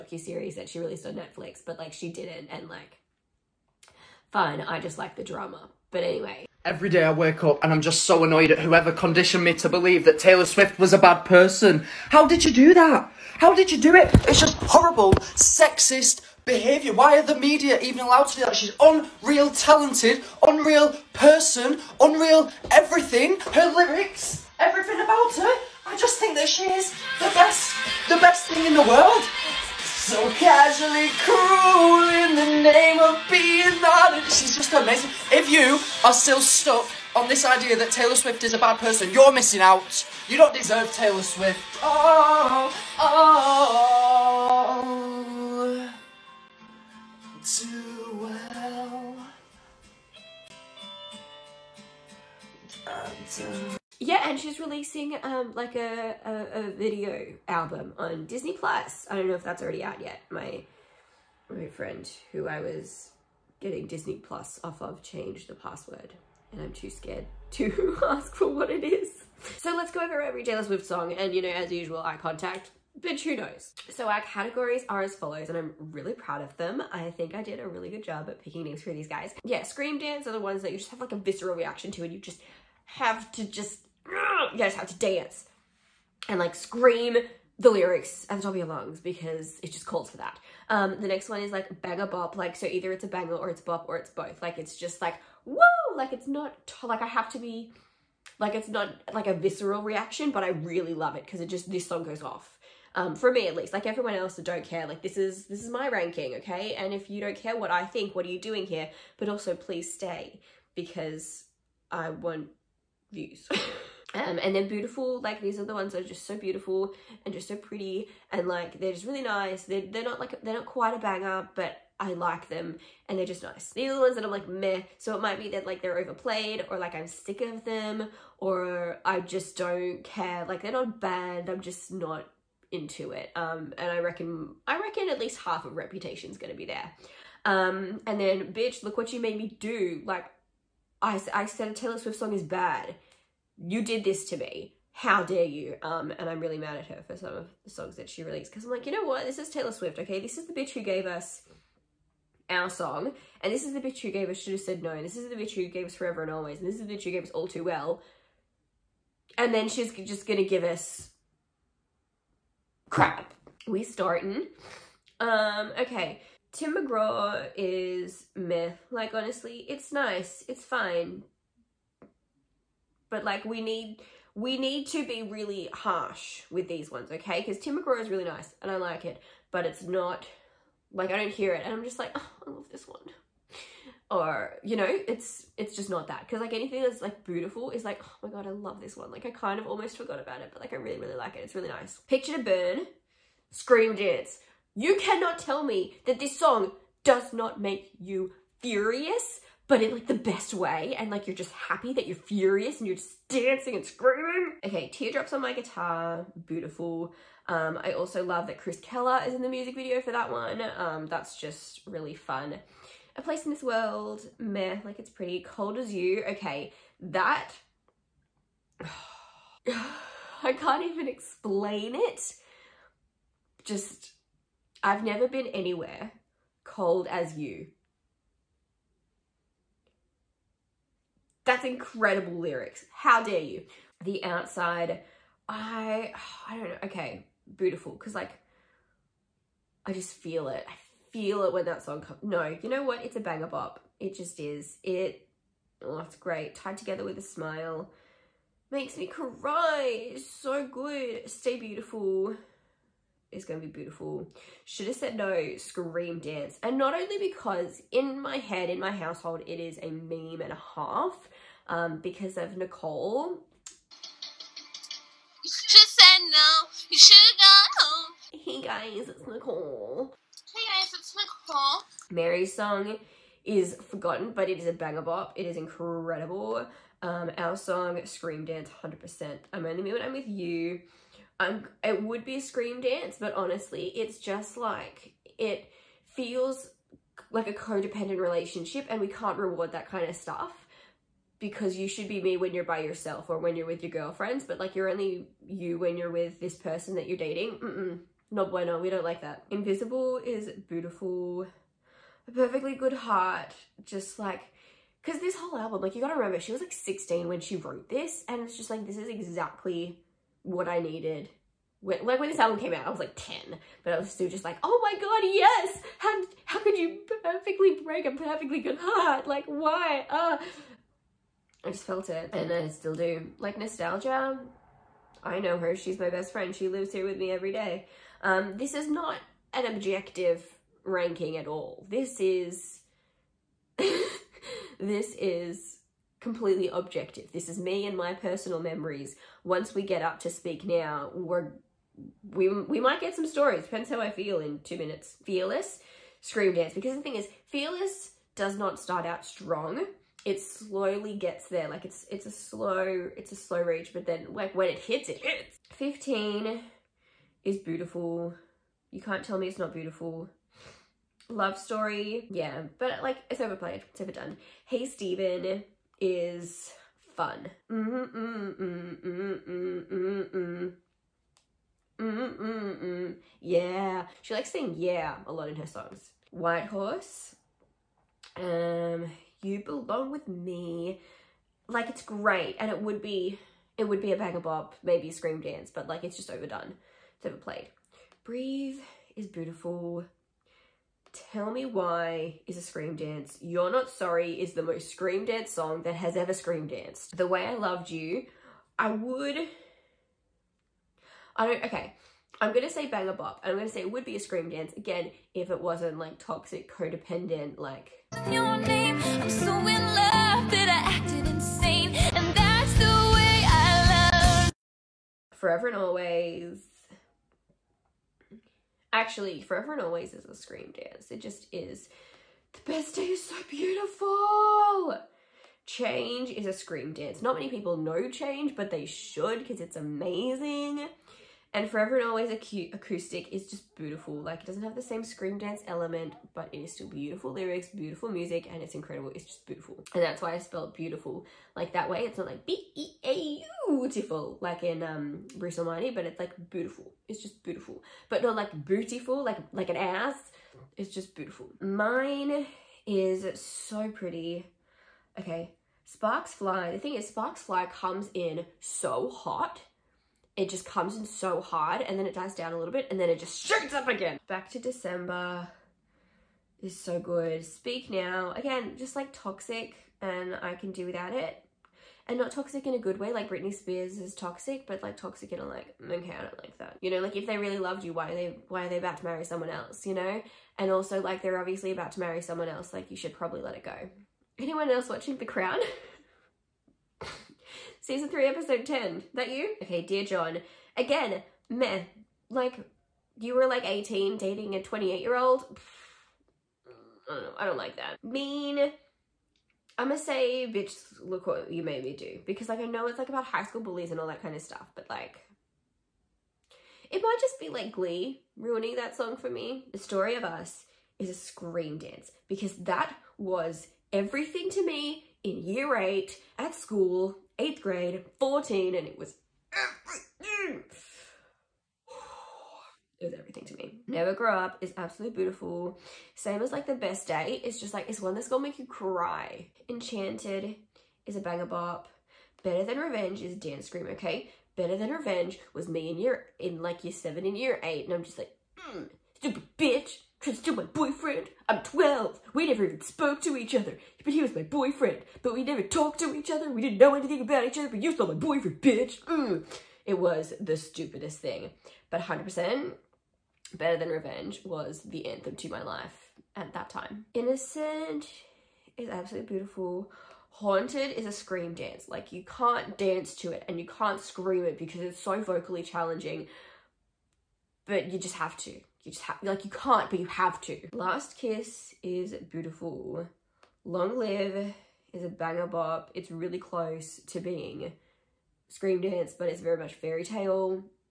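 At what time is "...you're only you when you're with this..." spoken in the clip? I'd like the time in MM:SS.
04:54.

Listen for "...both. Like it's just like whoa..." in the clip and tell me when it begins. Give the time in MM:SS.
01:34.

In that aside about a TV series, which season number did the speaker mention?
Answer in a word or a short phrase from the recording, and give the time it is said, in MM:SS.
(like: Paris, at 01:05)
3, at 08:07.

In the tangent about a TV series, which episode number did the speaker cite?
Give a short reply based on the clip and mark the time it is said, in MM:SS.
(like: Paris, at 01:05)
10, at 08:08.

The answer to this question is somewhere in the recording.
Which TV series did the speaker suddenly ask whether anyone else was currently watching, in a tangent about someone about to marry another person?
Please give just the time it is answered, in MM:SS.
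08:05.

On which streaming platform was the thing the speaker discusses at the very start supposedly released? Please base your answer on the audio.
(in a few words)
Netflix.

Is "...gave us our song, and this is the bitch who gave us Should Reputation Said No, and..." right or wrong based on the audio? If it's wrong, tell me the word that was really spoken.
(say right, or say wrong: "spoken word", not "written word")
wrong: "Have", not "Reputation".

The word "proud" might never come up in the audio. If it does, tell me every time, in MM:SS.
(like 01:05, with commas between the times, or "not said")
01:16.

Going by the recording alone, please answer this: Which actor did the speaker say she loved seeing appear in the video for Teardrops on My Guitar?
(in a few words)
Chris Keller.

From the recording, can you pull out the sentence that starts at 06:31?
Tell Me Why is a scream dance.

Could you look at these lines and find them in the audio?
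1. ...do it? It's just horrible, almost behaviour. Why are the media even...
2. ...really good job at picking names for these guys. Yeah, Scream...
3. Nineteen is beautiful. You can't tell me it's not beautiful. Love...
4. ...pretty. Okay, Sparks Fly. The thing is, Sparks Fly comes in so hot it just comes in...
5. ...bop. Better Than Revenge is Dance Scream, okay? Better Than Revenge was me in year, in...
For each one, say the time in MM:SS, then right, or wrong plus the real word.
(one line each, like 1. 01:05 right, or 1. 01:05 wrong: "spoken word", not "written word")
1. 00:13 wrong: "sexist", not "almost"
2. 01:17 right
3. 05:55 wrong: "Fifteen", not "Nineteen"
4. 07:33 right
5. 08:51 right.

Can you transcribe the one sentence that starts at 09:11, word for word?
But 100% better than revenge was the anthem to my life at that time.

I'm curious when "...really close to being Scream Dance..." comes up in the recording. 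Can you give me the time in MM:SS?
09:36.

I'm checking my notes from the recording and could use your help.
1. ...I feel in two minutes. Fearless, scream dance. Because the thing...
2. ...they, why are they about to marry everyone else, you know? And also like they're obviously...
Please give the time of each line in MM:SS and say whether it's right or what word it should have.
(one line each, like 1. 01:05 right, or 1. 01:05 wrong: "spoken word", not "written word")
1. 05:44 right
2. 07:58 wrong: "someone", not "everyone".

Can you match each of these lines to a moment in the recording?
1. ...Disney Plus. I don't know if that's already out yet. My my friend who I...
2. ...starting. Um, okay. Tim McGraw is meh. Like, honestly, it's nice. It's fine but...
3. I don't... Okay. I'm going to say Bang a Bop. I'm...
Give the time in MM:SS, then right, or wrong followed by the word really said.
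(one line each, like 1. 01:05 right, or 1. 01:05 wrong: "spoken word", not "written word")
1. 00:58 right
2. 02:43 right
3. 06:41 right.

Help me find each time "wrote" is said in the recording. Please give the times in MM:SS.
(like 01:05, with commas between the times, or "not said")
05:07.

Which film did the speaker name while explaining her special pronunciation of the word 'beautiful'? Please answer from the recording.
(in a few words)
Bruce Almighty.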